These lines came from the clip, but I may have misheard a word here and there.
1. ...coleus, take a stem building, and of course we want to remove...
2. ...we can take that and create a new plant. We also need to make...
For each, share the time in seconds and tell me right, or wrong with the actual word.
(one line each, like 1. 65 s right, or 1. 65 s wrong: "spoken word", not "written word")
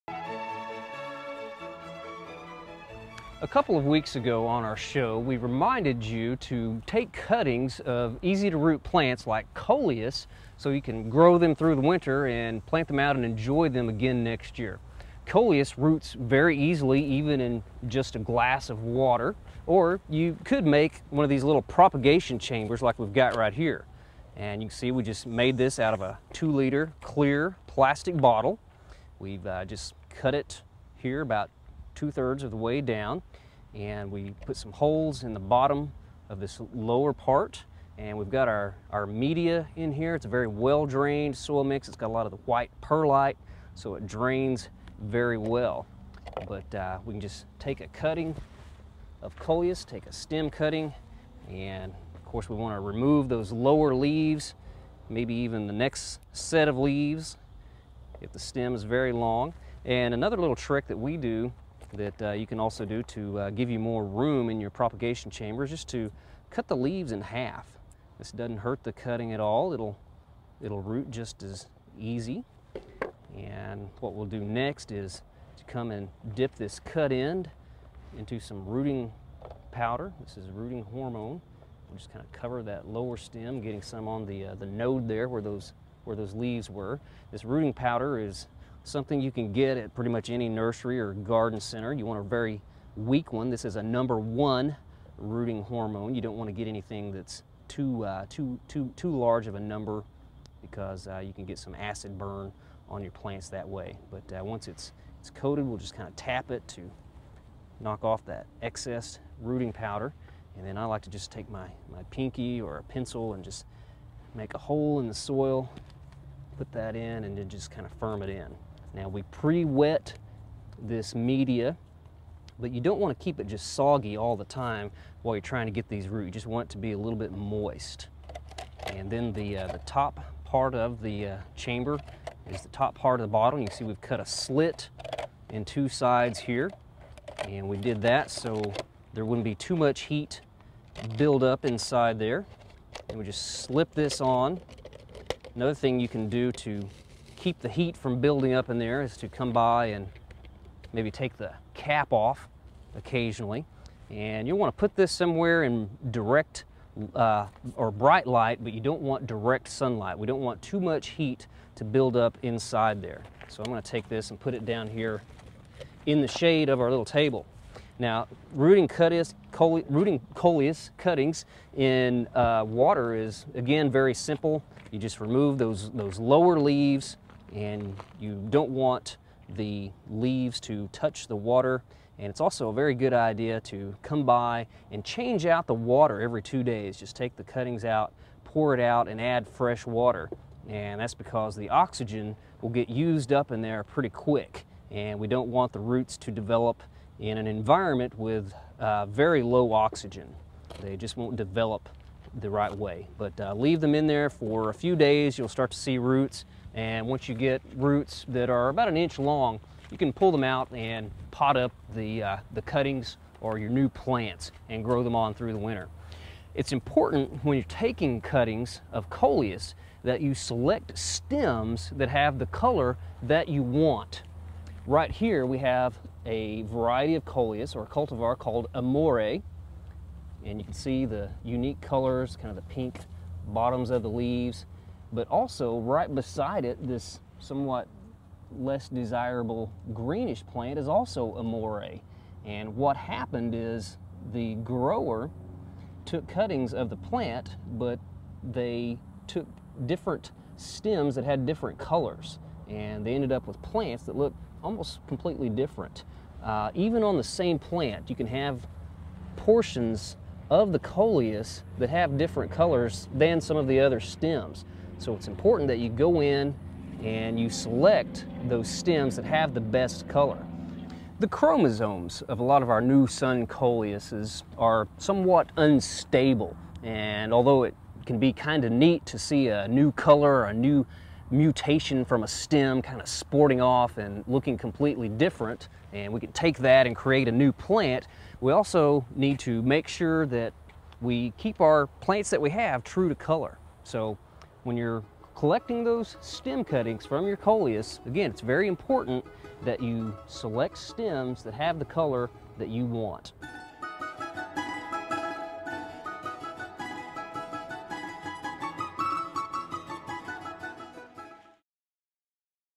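1. 49 s wrong: "cutting", not "building"
2. 286 s right.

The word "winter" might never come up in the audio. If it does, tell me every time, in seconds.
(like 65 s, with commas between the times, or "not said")
11 s, 215 s.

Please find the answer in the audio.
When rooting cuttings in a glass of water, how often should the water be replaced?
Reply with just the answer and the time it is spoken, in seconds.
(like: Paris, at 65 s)
Every 2 days, at 186 s.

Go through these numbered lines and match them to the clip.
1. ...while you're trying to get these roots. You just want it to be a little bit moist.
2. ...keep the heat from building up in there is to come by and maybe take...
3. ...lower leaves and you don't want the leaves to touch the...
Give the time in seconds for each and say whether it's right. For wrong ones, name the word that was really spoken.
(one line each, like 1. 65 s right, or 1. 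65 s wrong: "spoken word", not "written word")
1. 125 s right
2. 147 s right
3. 176 s right.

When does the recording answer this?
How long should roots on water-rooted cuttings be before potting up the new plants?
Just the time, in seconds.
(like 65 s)
208 s.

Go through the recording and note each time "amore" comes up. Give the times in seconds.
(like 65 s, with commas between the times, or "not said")
228 s, 241 s.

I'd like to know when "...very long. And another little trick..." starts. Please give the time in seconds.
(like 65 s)
58 s.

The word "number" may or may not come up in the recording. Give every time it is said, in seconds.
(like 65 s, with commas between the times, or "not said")
93 s, 99 s.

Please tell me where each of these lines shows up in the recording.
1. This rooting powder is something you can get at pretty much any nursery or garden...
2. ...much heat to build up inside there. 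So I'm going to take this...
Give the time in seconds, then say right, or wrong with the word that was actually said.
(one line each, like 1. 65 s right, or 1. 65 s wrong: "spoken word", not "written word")
1. 87 s right
2. 160 s right.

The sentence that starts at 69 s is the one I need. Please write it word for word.
It'll, it'll root just as easy.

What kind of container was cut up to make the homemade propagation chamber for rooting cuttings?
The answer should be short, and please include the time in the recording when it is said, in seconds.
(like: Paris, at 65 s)
Two liter clear plastic bottle, at 26 s.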